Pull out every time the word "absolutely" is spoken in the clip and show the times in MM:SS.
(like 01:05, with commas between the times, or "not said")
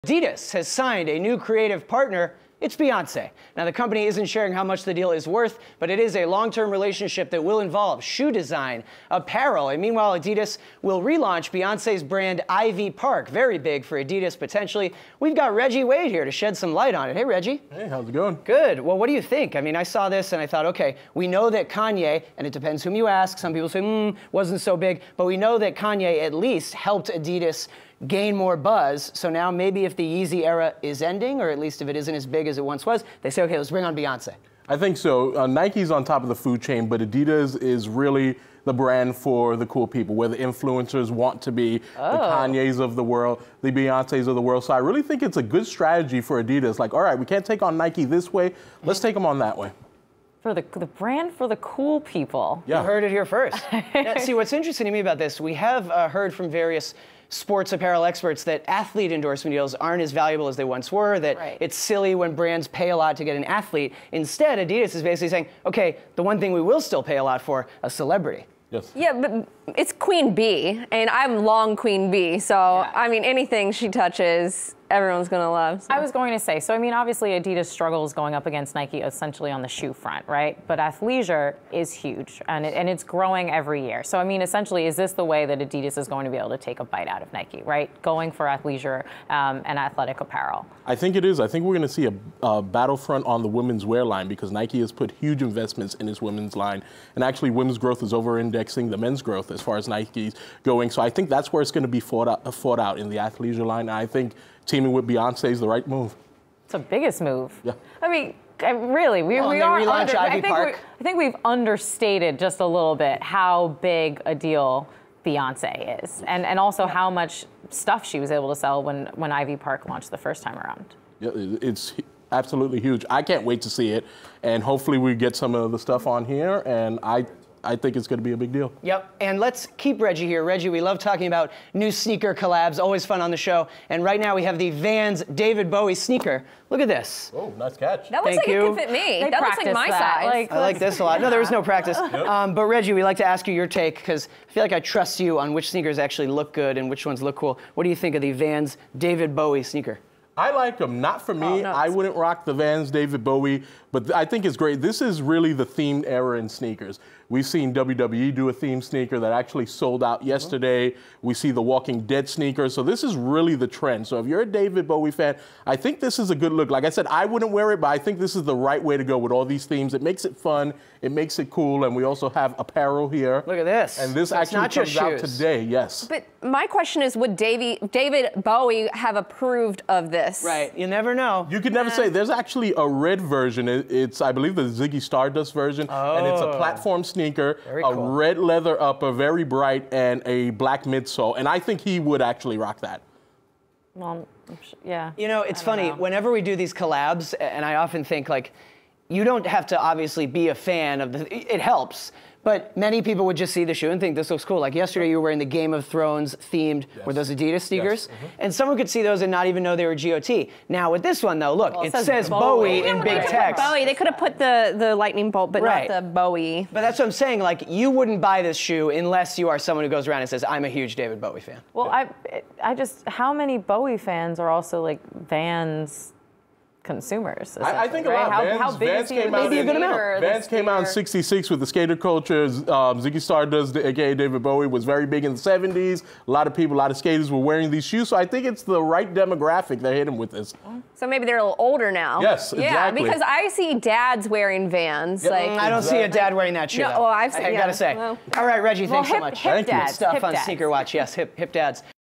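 02:02.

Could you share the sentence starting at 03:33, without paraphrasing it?
Bowie, they could have put the the lightning bolt, but right.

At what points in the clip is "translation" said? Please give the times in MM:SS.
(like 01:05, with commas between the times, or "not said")
not said.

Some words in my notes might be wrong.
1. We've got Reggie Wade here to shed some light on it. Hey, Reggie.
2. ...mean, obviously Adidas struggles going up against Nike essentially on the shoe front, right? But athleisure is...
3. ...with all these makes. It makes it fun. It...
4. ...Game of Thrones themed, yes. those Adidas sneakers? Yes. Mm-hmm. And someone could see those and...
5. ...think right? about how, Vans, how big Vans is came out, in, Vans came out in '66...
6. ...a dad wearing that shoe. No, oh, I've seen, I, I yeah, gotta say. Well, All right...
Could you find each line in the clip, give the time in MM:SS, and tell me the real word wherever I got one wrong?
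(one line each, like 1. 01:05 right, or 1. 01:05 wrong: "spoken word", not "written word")
1. 00:15 right
2. 01:16 right
3. 02:49 wrong: "themes", not "makes"
4. 03:25 right
5. 03:47 right
6. 04:06 right.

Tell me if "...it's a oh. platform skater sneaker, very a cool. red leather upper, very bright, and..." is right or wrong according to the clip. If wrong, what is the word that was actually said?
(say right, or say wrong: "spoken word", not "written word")
wrong: "sneaker", not "skater".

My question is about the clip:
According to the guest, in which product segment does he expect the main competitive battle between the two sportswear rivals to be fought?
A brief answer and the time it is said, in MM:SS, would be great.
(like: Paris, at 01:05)
Women's wear, at 01:33.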